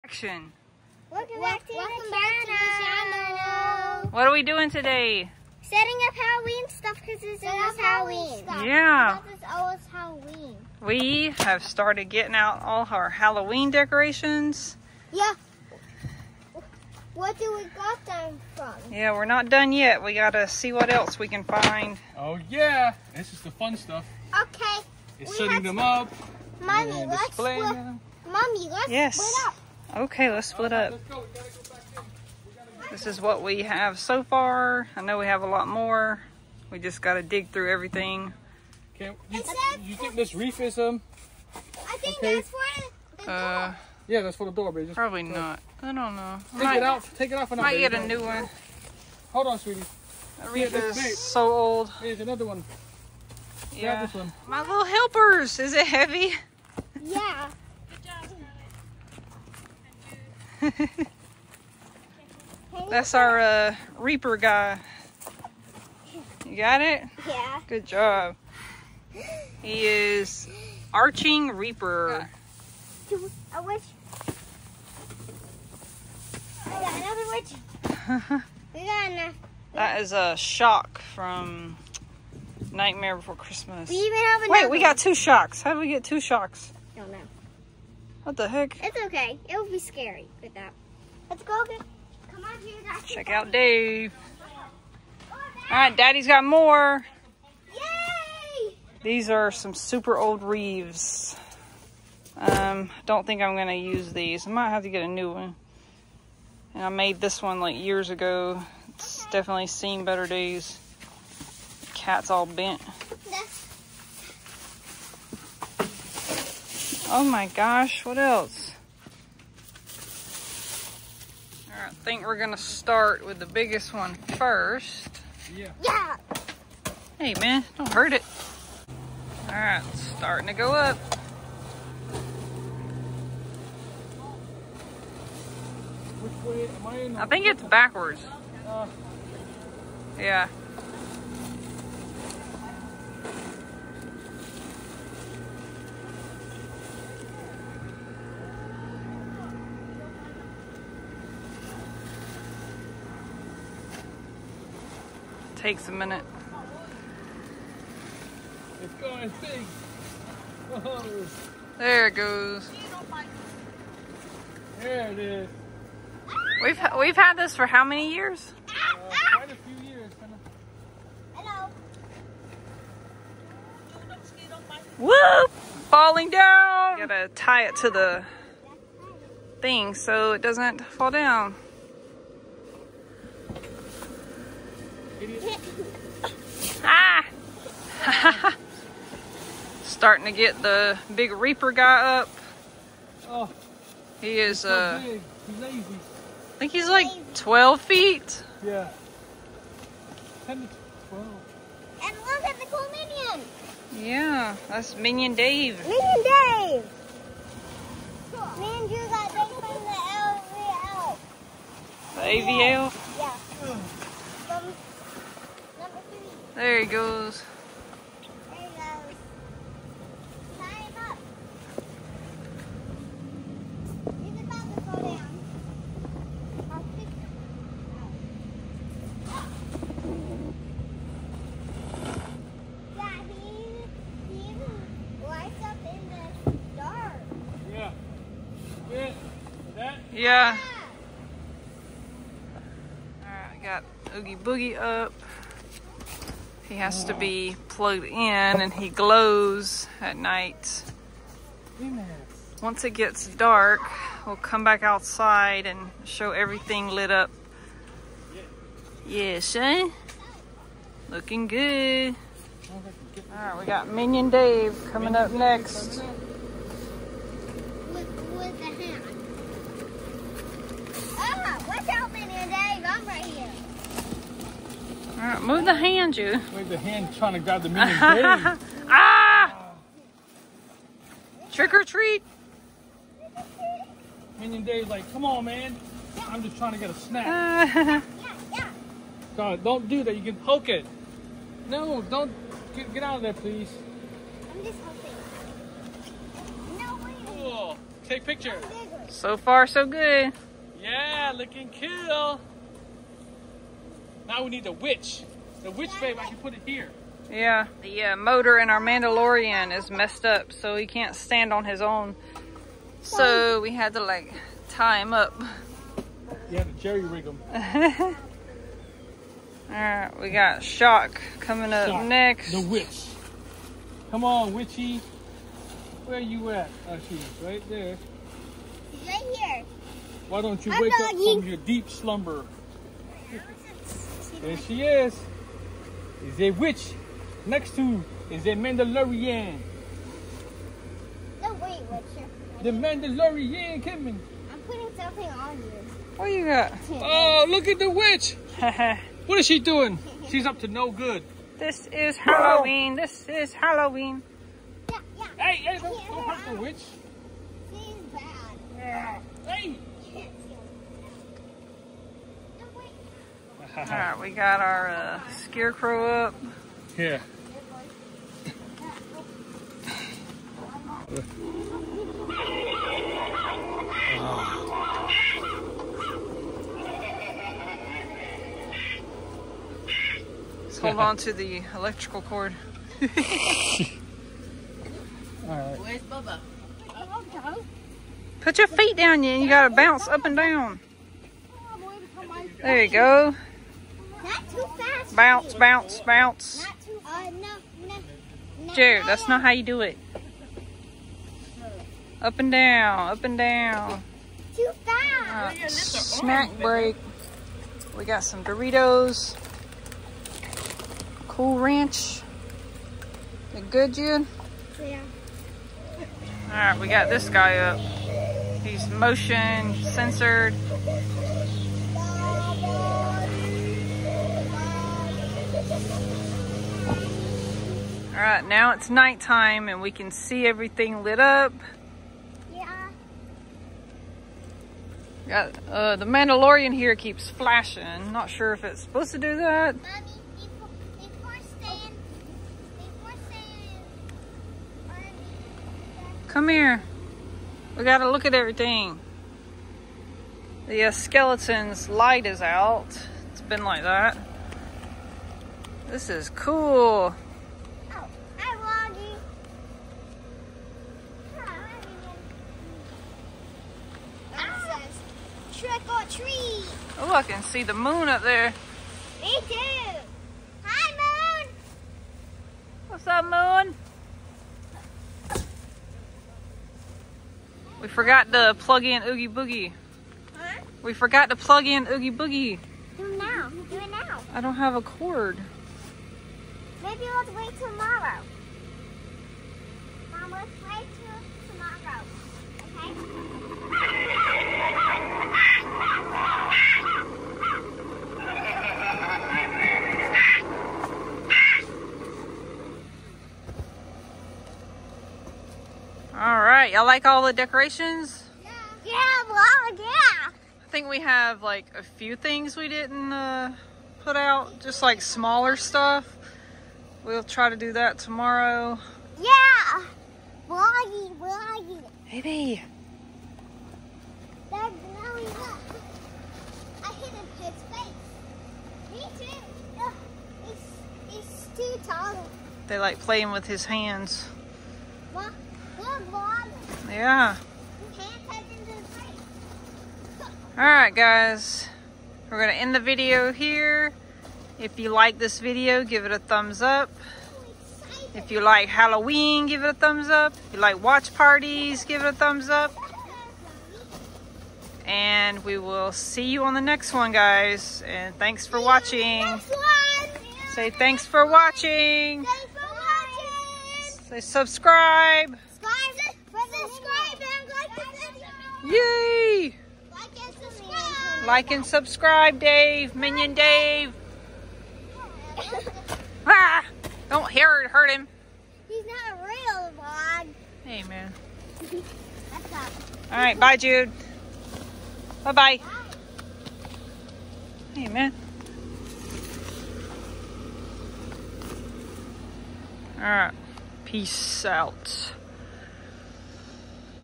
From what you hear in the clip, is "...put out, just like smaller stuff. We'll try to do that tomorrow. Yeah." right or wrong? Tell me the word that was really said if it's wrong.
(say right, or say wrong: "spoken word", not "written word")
right.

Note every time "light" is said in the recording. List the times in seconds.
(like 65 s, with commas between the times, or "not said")
451 s.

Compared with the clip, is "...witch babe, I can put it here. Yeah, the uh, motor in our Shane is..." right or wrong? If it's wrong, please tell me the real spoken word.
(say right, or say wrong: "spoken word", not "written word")
wrong: "Mandalorian", not "Shane".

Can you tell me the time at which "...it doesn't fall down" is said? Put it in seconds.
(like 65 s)
180 s.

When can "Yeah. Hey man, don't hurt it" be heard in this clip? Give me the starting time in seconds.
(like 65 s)
125 s.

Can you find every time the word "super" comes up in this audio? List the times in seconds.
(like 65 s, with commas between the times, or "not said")
99 s.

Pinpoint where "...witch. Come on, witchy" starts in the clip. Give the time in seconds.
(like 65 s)
322 s.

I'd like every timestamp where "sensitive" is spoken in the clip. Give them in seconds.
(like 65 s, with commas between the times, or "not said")
not said.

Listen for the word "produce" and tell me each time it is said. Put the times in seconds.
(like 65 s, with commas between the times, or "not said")
not said.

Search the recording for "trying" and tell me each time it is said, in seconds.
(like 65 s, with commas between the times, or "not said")
277 s, 286 s.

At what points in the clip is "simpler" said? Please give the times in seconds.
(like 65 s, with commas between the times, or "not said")
not said.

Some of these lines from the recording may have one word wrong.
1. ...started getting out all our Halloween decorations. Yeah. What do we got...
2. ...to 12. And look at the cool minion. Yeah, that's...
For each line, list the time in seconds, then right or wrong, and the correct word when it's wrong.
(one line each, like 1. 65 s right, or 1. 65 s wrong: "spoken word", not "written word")
1. 11 s right
2. 200 s right.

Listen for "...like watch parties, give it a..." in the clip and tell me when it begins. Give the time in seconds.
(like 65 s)
550 s.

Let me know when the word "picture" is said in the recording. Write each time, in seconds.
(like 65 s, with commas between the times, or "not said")
298 s.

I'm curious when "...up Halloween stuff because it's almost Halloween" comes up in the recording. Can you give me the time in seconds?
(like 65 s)
6 s.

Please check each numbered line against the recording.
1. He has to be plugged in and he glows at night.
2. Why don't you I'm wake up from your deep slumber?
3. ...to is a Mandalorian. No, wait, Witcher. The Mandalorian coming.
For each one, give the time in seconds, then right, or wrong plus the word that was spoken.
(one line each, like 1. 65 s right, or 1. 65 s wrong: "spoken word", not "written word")
1. 246 s right
2. 330 s right
3. 337 s right.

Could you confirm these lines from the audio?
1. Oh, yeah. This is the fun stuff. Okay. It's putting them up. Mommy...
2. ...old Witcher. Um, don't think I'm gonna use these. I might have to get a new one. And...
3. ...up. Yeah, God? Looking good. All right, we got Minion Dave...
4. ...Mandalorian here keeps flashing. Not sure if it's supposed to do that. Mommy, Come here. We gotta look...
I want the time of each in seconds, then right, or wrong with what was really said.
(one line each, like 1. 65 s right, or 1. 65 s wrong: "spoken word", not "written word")
1. 22 s wrong: "setting", not "putting"
2. 100 s wrong: "Reeves", not "Witcher"
3. 257 s wrong: "Shane", not "God"
4. 436 s right.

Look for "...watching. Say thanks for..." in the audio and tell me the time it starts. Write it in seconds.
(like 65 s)
558 s.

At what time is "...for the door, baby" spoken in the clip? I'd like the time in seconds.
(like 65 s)
44 s.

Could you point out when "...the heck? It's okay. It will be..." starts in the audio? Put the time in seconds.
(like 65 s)
88 s.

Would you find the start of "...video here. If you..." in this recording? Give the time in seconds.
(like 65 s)
542 s.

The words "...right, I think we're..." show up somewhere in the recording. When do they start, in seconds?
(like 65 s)
121 s.